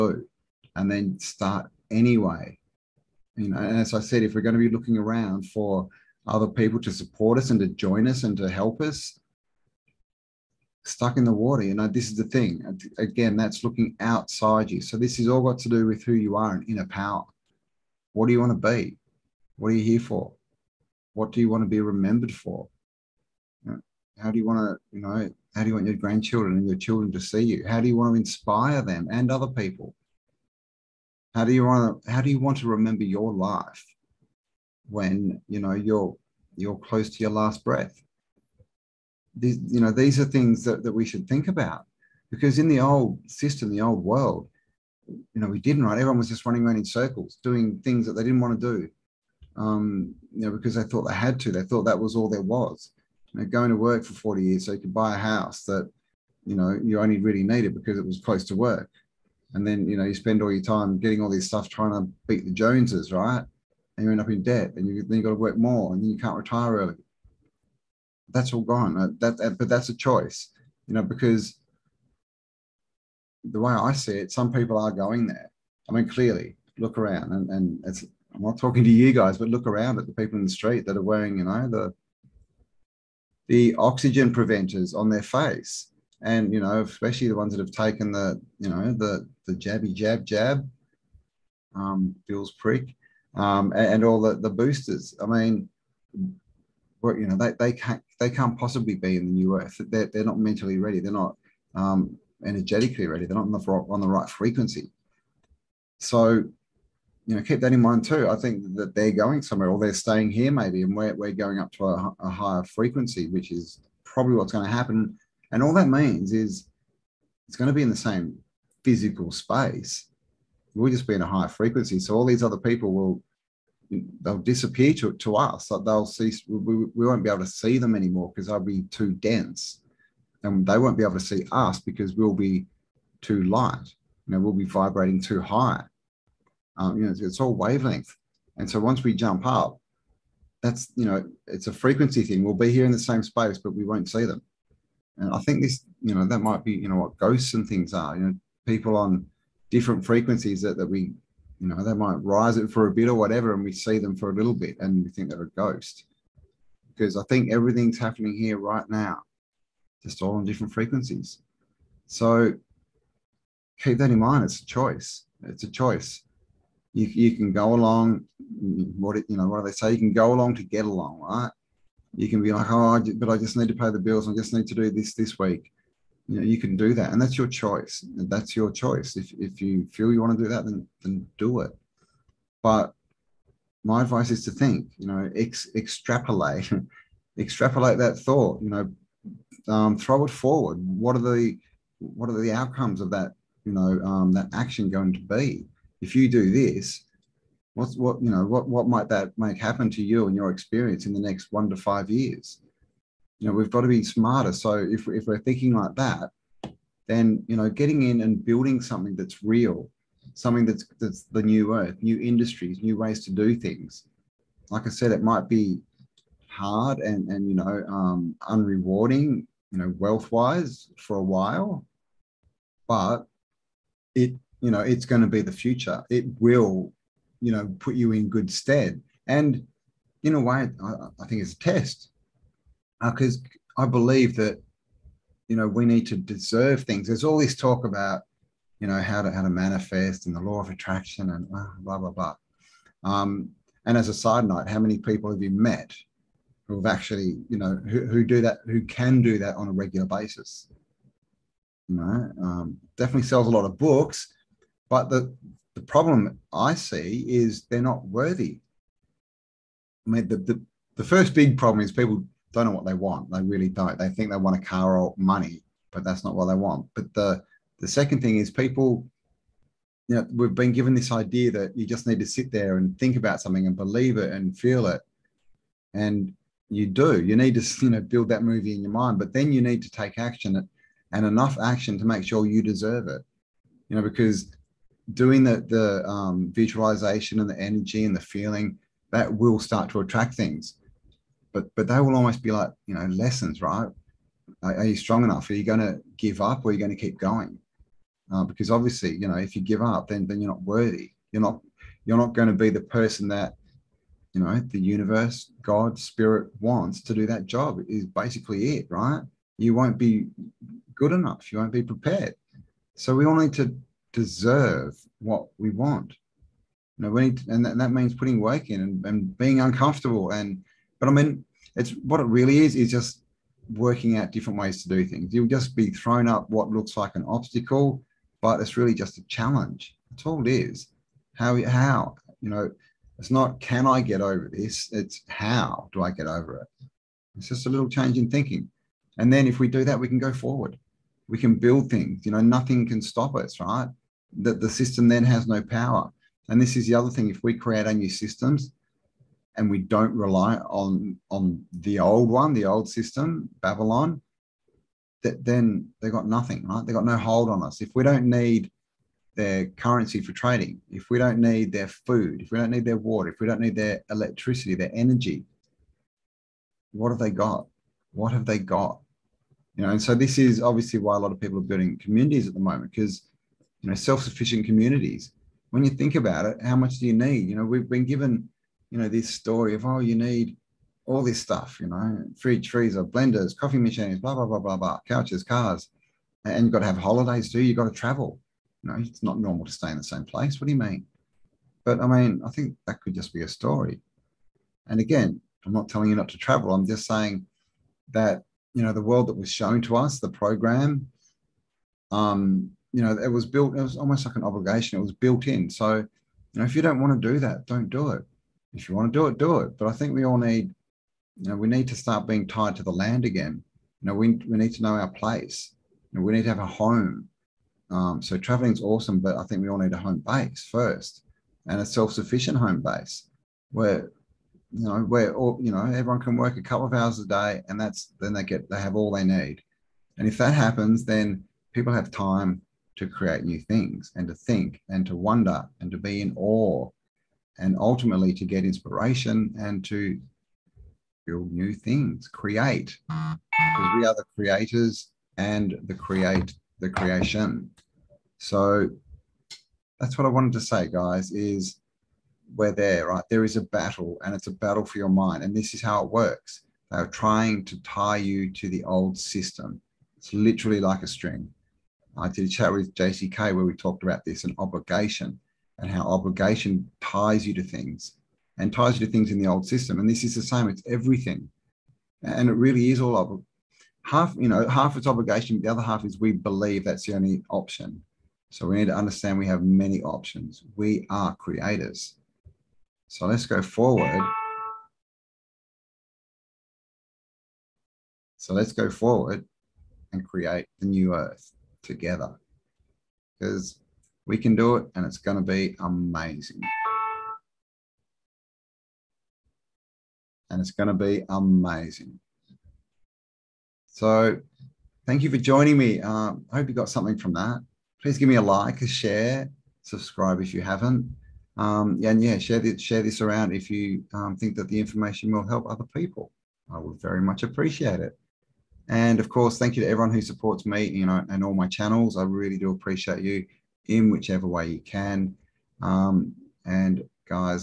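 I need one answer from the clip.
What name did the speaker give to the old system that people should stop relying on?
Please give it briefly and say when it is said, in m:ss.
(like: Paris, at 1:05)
Babylon, at 5:53.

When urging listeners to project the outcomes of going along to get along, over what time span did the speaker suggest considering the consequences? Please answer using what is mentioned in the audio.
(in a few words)
1 to 5 years.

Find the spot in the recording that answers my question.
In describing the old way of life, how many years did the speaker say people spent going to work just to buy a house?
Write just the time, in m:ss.
0:54.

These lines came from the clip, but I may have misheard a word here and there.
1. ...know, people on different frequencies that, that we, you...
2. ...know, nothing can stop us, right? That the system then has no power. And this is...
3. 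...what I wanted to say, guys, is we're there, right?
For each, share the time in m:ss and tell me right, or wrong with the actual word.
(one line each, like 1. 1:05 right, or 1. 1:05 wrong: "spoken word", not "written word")
1. 2:28 right
2. 5:42 right
3. 7:30 right.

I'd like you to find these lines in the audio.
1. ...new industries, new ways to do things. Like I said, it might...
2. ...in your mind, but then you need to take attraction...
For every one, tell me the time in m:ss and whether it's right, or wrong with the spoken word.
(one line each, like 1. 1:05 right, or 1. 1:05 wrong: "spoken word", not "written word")
1. 3:32 right
2. 4:38 wrong: "action", not "attraction".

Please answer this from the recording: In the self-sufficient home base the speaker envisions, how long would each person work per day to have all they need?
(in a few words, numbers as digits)
A couple of hours.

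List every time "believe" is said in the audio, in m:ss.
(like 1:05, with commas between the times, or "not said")
3:53, 4:33, 7:56.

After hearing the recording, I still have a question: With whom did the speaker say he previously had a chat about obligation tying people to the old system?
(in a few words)
JC Kay.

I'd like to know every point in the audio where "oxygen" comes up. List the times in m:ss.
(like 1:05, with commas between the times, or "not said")
1:23.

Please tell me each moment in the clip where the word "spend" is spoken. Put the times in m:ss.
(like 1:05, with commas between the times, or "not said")
1:00.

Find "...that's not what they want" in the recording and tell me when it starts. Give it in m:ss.
4:26.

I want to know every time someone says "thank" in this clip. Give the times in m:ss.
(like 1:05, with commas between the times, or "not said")
8:25, 8:39.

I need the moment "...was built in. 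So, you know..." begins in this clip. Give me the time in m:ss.
6:45.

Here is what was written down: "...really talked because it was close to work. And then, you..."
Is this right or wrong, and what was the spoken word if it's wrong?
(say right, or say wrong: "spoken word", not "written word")
wrong: "needed", not "talked".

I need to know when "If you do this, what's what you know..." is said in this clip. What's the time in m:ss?
3:16.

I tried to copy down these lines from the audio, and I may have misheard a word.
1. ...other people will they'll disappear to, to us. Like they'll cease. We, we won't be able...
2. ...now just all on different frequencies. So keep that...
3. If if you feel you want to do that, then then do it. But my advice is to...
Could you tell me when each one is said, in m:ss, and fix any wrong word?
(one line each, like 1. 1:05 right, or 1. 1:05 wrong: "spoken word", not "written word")
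1. 2:02 right
2. 2:38 right
3. 2:59 right.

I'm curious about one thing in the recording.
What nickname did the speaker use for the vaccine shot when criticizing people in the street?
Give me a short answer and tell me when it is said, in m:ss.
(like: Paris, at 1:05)
Bill's prick, at 1:32.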